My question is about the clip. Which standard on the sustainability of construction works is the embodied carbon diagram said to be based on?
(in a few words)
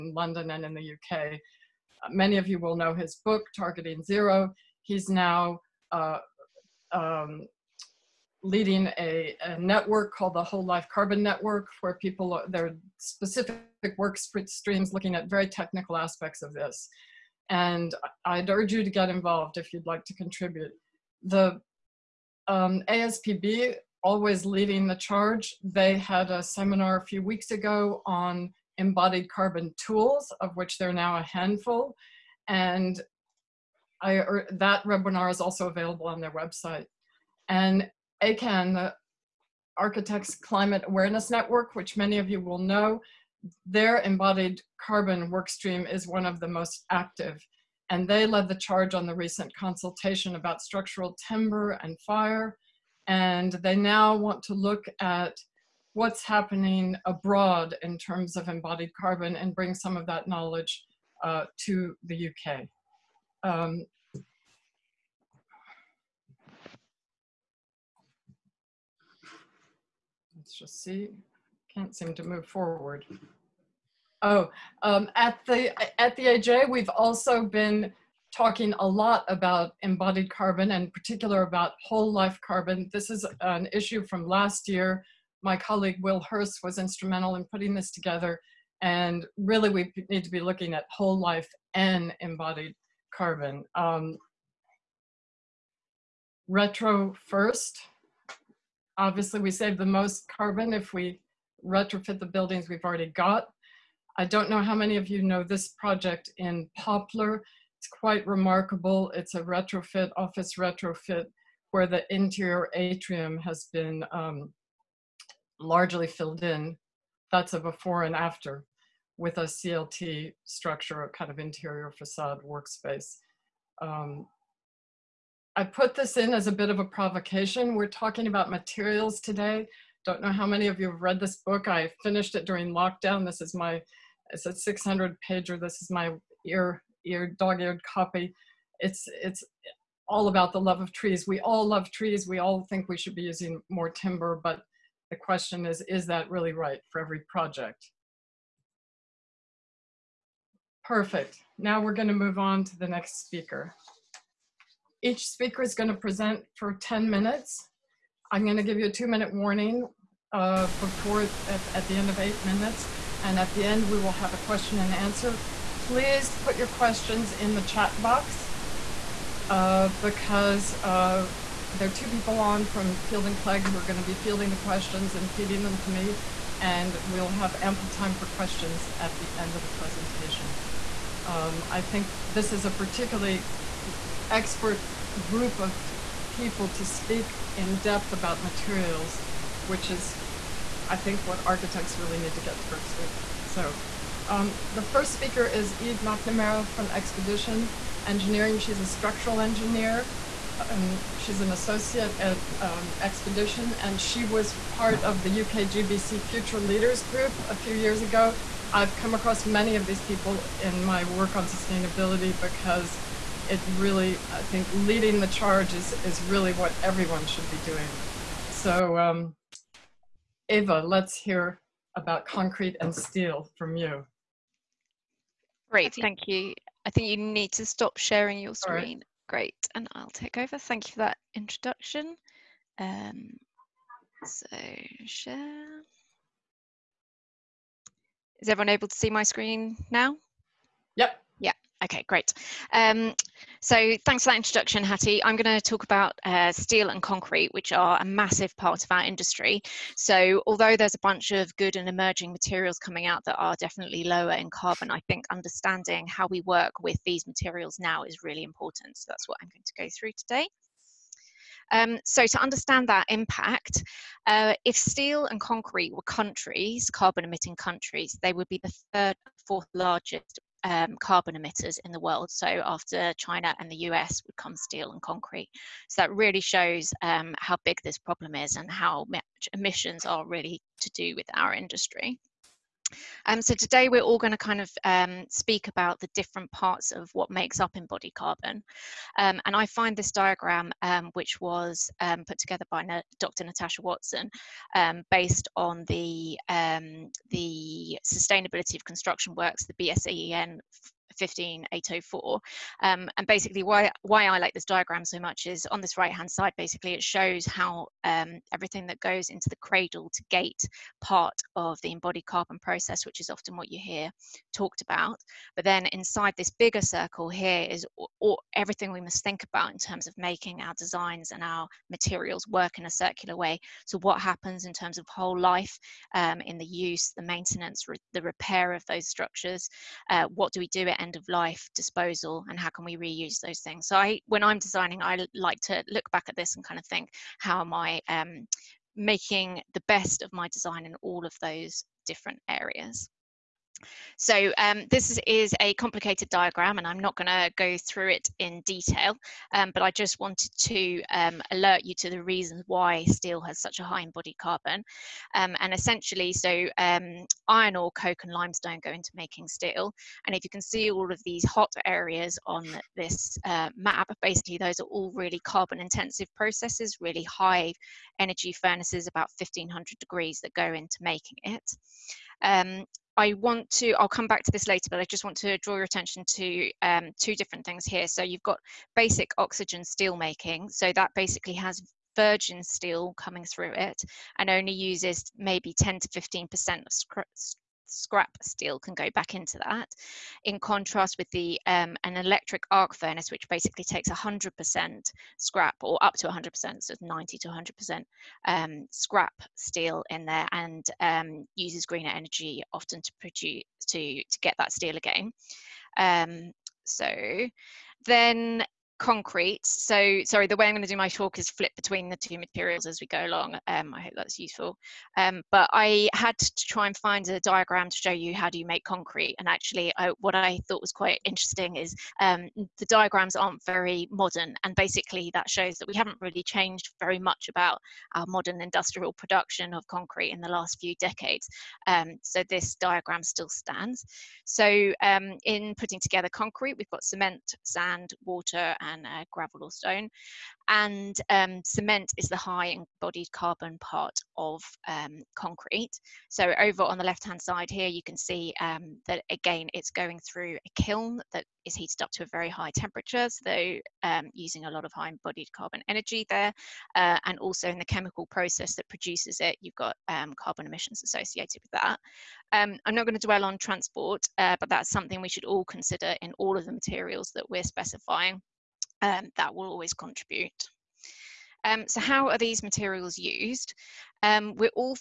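BS EN 15804.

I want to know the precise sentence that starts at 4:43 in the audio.
Um, so today we're all going to kind of um, speak about the different parts of what makes up embodied carbon.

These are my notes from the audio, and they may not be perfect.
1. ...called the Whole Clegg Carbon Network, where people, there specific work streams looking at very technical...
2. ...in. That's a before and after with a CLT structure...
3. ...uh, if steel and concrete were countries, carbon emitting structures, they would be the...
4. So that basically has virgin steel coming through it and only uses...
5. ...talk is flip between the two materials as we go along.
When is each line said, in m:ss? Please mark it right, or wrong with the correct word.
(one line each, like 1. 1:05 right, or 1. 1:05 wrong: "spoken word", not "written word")
1. 0:10 wrong: "Life", not "Clegg"
2. 1:56 right
3. 4:24 wrong: "countries", not "structures"
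4. 6:20 right
5. 6:51 right.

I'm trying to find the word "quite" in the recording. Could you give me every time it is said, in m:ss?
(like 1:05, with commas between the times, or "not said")
1:47, 7:00.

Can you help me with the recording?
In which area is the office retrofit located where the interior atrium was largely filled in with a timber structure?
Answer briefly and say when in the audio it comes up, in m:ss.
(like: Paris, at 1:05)
Poplar, at 1:46.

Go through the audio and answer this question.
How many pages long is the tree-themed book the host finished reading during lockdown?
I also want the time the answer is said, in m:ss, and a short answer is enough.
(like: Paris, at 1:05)
600, at 2:14.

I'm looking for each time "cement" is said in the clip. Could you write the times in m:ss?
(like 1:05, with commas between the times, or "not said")
7:17, 7:21.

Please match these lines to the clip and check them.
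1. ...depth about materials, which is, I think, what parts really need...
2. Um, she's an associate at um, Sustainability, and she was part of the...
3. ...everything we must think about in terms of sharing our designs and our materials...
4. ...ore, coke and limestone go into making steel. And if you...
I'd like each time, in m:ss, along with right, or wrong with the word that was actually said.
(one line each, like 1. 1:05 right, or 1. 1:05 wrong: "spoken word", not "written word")
1. 3:07 wrong: "architects", not "parts"
2. 3:20 wrong: "Expedition", not "Sustainability"
3. 5:18 wrong: "making", not "sharing"
4. 5:57 right.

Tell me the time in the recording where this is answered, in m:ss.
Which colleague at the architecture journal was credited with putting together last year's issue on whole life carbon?
1:26.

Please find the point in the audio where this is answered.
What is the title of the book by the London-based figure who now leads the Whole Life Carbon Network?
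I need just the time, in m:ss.
0:03.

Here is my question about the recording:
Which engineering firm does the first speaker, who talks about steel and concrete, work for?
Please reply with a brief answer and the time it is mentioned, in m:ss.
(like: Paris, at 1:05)
Expedition Engineering, at 3:16.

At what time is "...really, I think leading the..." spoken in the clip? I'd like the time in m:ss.
3:33.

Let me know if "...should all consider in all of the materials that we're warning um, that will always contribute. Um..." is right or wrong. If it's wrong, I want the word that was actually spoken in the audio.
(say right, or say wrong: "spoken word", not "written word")
wrong: "specifying", not "warning".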